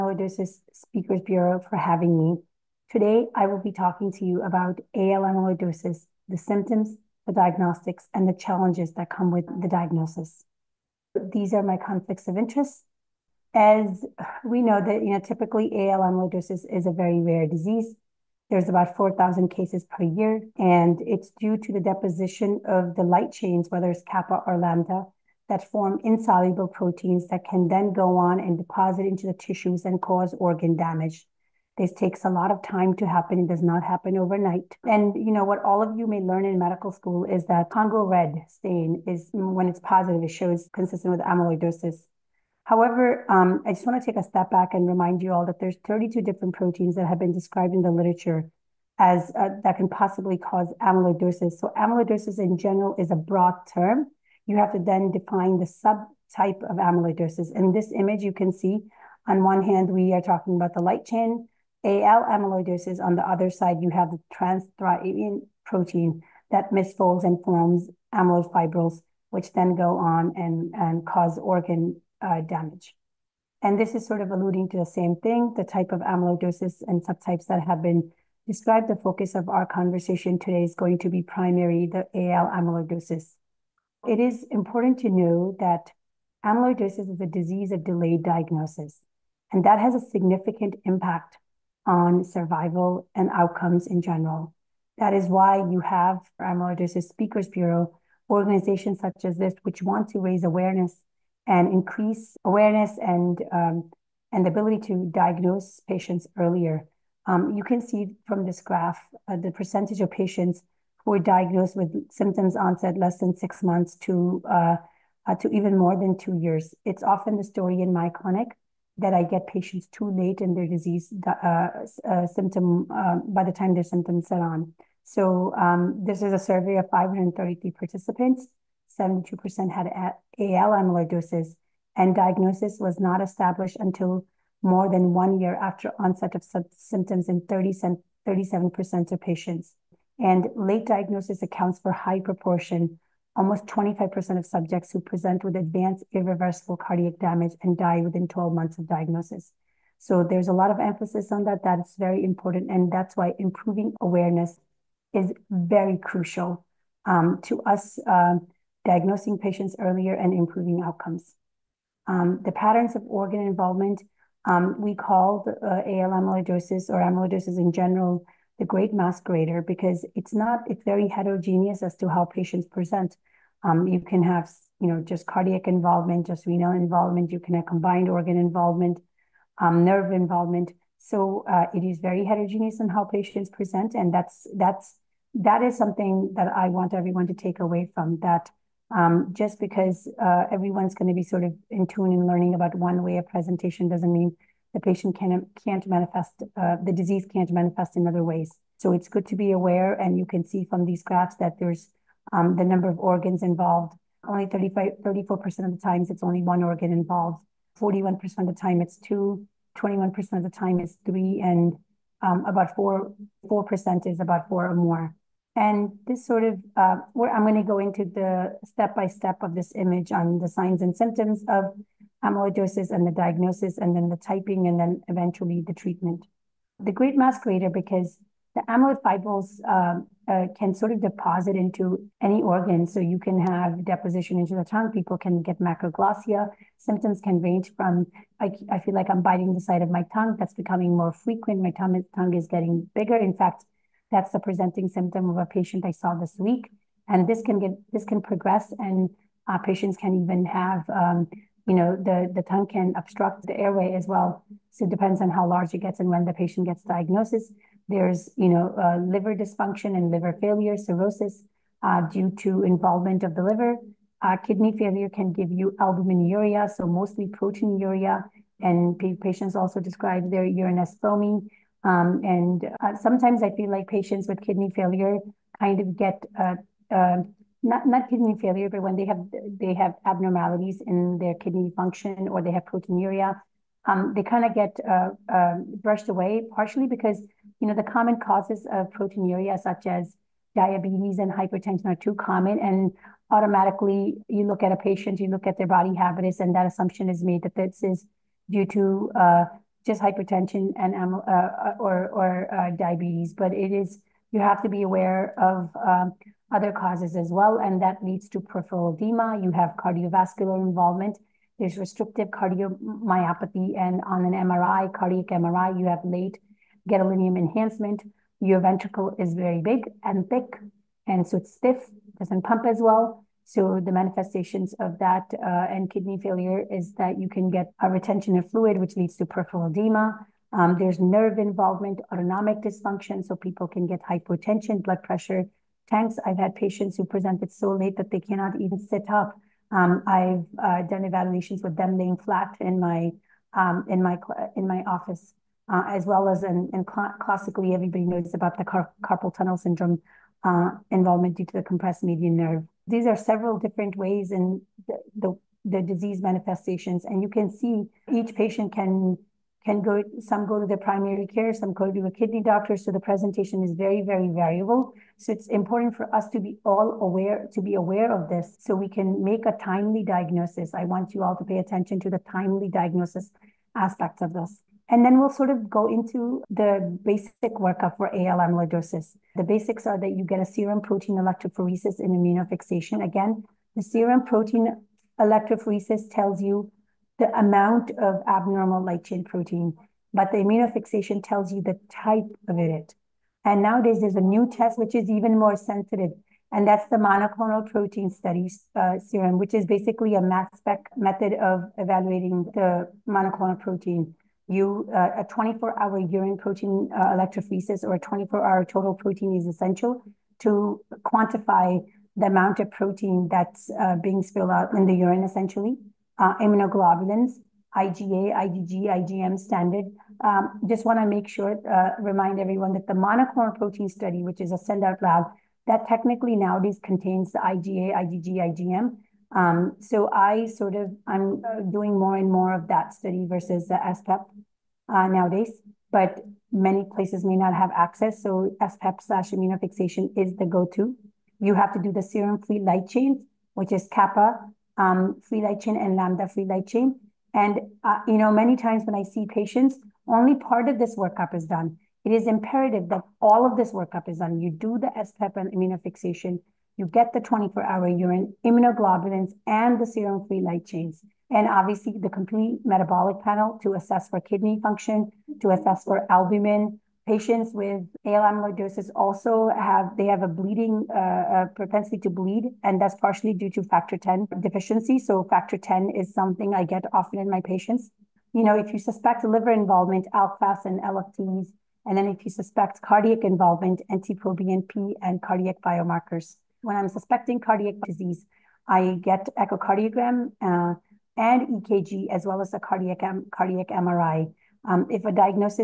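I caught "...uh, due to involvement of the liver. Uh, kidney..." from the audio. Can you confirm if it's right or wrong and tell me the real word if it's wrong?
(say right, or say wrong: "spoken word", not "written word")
right.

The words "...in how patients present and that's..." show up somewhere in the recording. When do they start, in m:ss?
3:02.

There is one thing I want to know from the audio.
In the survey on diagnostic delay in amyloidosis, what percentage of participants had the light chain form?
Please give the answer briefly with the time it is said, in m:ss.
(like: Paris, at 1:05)
72%, at 2:08.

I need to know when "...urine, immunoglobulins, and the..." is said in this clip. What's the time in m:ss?
7:37.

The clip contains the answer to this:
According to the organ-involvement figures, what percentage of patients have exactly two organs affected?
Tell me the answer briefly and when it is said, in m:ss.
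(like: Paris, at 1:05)
41%, at 3:27.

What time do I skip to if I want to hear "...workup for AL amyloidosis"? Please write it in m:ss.
6:17.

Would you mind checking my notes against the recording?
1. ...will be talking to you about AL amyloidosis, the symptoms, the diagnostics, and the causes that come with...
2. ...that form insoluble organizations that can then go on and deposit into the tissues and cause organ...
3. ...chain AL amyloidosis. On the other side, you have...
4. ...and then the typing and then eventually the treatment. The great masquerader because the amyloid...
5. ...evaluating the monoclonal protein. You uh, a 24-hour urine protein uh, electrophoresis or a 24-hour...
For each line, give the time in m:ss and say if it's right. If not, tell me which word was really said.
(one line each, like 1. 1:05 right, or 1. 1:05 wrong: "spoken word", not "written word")
1. 0:03 wrong: "challenges", not "causes"
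2. 0:25 wrong: "proteins", not "organizations"
3. 1:01 right
4. 3:43 right
5. 6:41 right.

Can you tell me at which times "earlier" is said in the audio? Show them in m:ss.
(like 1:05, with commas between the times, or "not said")
1:46, 2:39.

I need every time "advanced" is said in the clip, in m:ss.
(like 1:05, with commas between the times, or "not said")
2:25.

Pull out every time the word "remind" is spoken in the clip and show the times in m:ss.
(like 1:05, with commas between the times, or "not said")
0:44, 7:02.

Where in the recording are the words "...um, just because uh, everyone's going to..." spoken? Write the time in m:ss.
3:08.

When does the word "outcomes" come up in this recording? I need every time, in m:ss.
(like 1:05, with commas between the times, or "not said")
1:33, 2:40.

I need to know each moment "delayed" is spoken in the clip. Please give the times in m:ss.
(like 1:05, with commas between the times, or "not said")
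1:27.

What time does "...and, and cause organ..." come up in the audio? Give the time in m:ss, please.
1:10.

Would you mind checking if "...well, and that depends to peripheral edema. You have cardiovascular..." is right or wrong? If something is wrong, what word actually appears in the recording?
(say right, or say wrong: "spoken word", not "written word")
wrong: "leads", not "depends".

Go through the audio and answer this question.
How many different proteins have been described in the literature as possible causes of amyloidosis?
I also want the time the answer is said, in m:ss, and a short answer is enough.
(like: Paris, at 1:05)
32, at 0:45.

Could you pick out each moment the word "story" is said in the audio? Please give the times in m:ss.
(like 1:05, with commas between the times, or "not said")
1:57.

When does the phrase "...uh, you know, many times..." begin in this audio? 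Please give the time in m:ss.
7:27.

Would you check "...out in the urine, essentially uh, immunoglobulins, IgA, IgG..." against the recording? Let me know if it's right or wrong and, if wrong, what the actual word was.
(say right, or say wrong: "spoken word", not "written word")
right.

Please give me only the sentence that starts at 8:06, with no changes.
When I'm suspecting cardiac disease, I get echocardiogram uh, and EKG as well as a cardiac cardiac MRI.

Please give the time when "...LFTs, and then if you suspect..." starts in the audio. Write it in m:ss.
8:00.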